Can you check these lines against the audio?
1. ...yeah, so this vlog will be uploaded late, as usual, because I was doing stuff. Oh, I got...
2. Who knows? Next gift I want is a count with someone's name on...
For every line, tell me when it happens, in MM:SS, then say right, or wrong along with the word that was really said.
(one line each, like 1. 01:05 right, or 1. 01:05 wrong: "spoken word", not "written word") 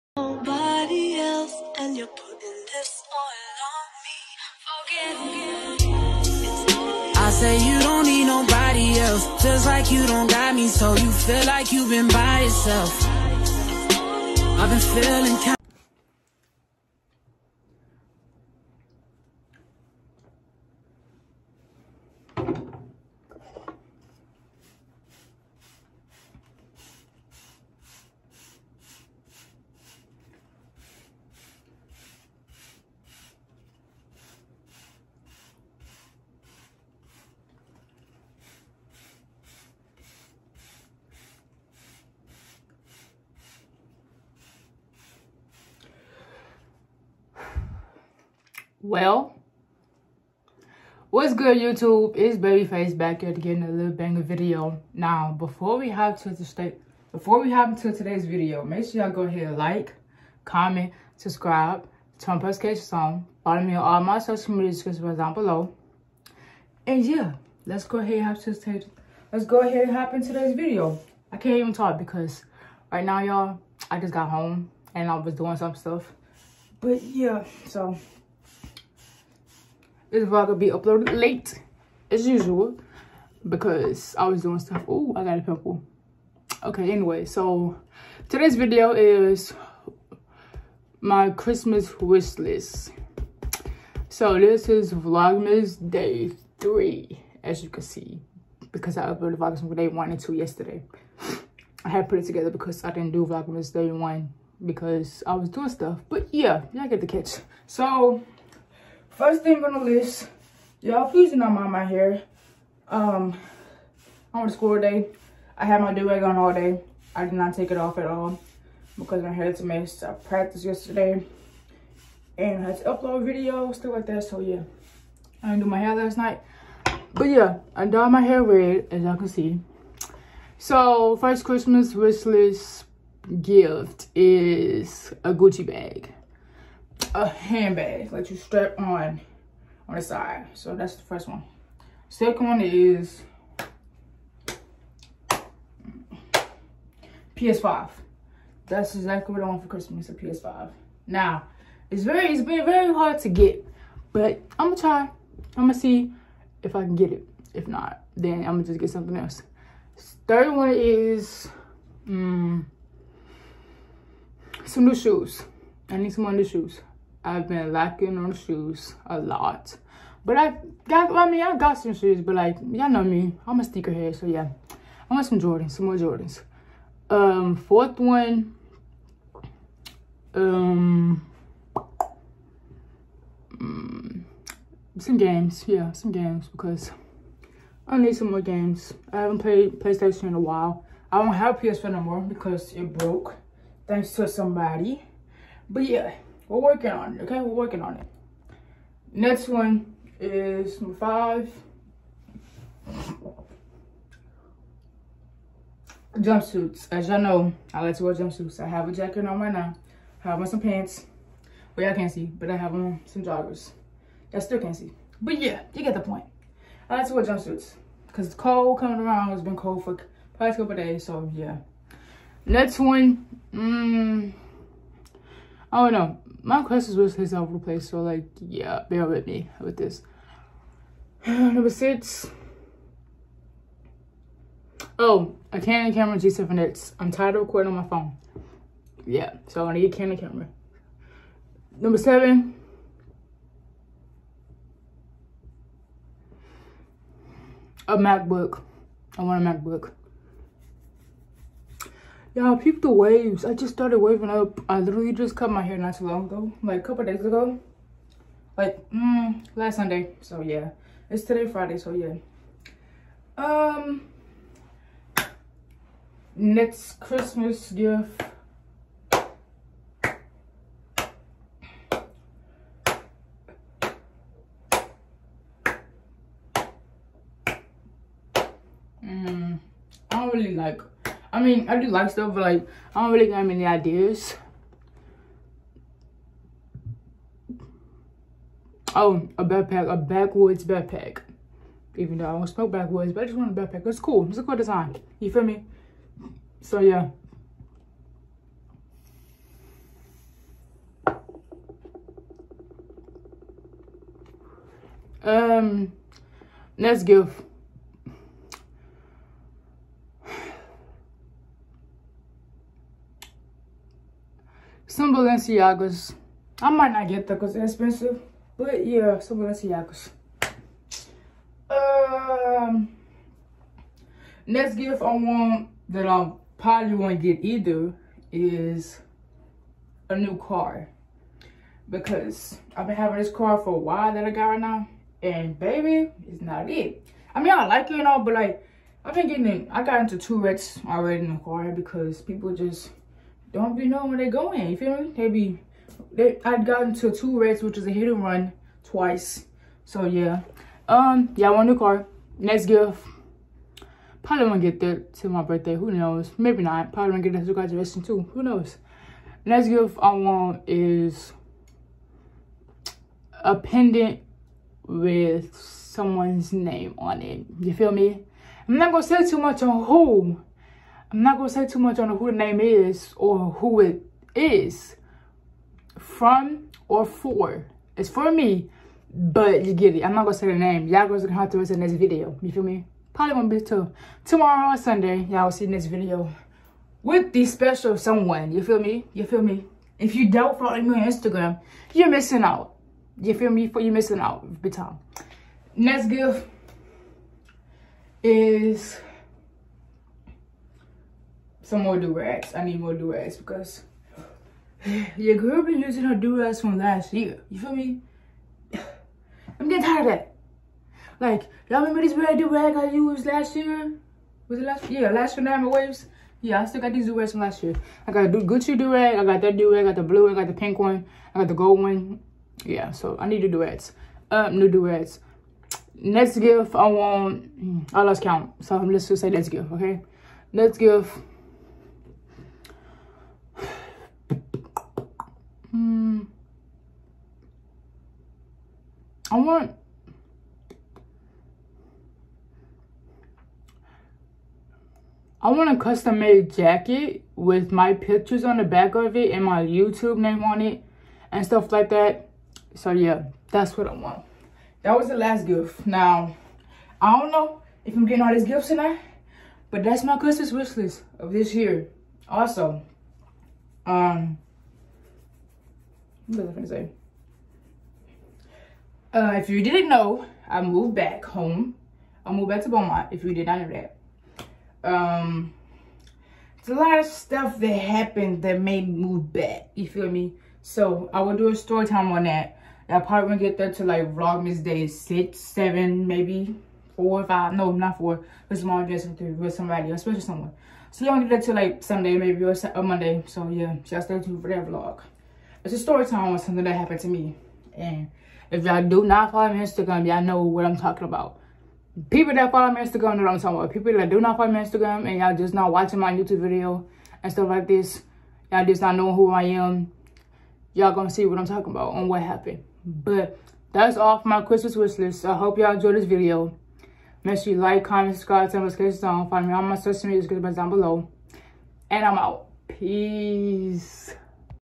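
1. 01:17 right
2. 05:58 wrong: "pendant", not "count".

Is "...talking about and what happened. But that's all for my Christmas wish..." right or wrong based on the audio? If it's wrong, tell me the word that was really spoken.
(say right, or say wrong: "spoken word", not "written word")
right.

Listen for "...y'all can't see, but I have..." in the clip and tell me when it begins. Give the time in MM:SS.
03:31.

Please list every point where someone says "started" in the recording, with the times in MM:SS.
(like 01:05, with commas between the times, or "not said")
04:13.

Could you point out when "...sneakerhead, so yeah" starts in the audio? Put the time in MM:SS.
02:53.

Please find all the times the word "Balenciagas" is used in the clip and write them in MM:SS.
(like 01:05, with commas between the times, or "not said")
05:15, 05:19.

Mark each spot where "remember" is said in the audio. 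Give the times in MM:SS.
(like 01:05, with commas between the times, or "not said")
06:51.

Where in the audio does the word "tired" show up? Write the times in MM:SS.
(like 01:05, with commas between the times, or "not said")
03:57, 06:49.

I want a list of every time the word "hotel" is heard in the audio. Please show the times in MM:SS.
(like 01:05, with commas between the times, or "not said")
not said.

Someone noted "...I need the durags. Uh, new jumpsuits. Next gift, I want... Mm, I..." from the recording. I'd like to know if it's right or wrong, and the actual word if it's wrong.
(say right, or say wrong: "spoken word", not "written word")
wrong: "duets", not "jumpsuits".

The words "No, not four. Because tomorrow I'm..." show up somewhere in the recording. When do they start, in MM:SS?
08:07.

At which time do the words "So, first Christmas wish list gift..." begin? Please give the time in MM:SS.
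02:10.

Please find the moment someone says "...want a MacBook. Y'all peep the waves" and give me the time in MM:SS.
04:09.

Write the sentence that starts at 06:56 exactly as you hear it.
Yeah, I still got these durags from last year.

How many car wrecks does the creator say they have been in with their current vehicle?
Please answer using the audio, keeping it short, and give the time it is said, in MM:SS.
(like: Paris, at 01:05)
2, at 05:40.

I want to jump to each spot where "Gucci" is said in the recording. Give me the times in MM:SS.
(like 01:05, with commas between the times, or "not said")
02:15, 06:58.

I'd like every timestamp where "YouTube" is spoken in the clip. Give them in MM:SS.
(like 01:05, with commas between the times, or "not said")
00:51, 07:29, 08:26.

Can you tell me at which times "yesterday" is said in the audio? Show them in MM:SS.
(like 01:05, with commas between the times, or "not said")
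01:40, 02:00.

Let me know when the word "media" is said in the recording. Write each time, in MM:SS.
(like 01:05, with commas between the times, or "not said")
01:04, 08:40.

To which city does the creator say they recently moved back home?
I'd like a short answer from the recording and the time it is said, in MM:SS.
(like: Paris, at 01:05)
Beaumont, at 07:52.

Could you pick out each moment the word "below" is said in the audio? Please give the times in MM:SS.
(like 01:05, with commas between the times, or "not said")
01:05, 08:40.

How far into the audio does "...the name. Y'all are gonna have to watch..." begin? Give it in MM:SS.
06:20.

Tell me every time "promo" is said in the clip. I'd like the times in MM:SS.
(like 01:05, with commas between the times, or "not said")
not said.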